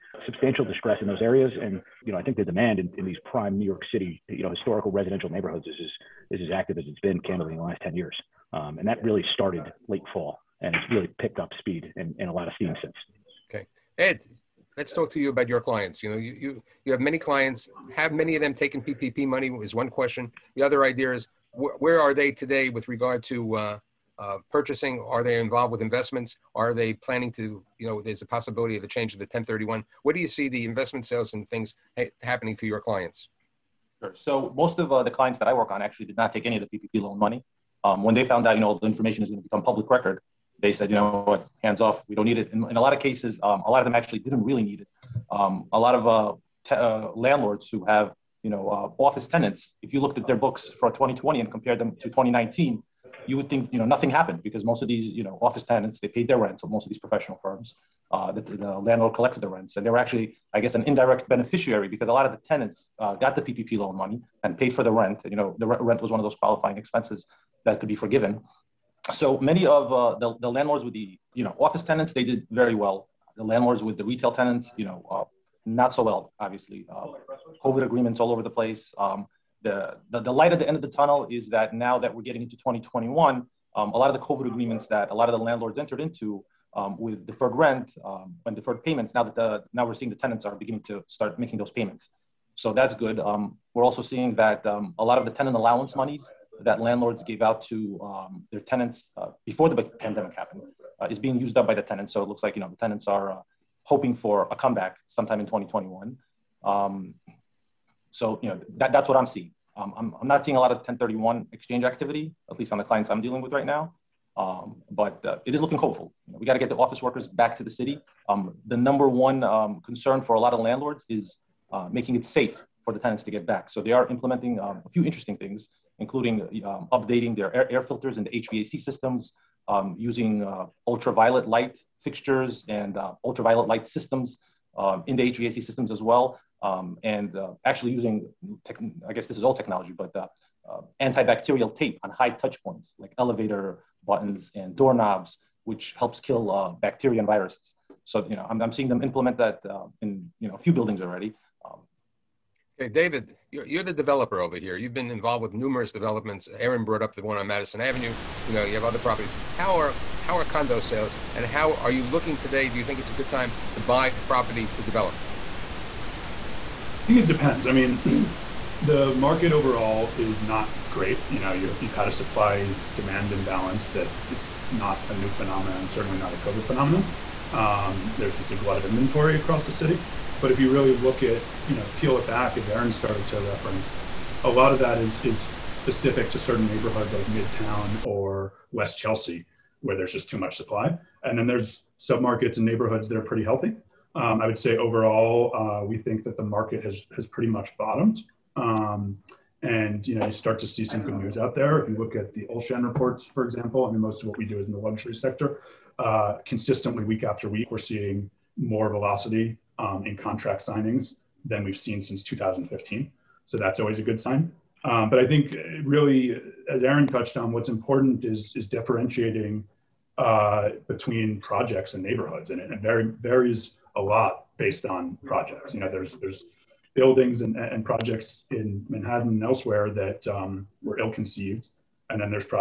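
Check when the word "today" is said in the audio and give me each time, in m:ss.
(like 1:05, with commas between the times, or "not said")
0:22, 2:42.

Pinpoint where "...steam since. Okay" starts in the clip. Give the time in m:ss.
0:12.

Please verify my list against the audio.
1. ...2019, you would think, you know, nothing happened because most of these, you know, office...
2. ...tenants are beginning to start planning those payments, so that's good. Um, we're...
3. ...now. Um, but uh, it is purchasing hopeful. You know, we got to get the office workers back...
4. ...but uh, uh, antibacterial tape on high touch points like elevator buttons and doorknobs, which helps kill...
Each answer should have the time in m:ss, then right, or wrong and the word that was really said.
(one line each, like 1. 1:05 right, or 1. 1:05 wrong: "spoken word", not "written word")
1. 0:52 right
2. 1:30 wrong: "making", not "planning"
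3. 1:53 wrong: "looking", not "purchasing"
4. 2:19 right.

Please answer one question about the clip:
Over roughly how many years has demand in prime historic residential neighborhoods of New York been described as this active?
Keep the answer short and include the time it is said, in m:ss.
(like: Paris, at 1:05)
10 years, at 0:07.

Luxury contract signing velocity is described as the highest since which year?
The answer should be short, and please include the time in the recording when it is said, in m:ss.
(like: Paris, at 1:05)
2015, at 3:32.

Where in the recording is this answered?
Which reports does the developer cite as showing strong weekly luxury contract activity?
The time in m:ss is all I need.
3:22.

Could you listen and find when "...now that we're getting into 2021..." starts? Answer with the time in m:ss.
1:21.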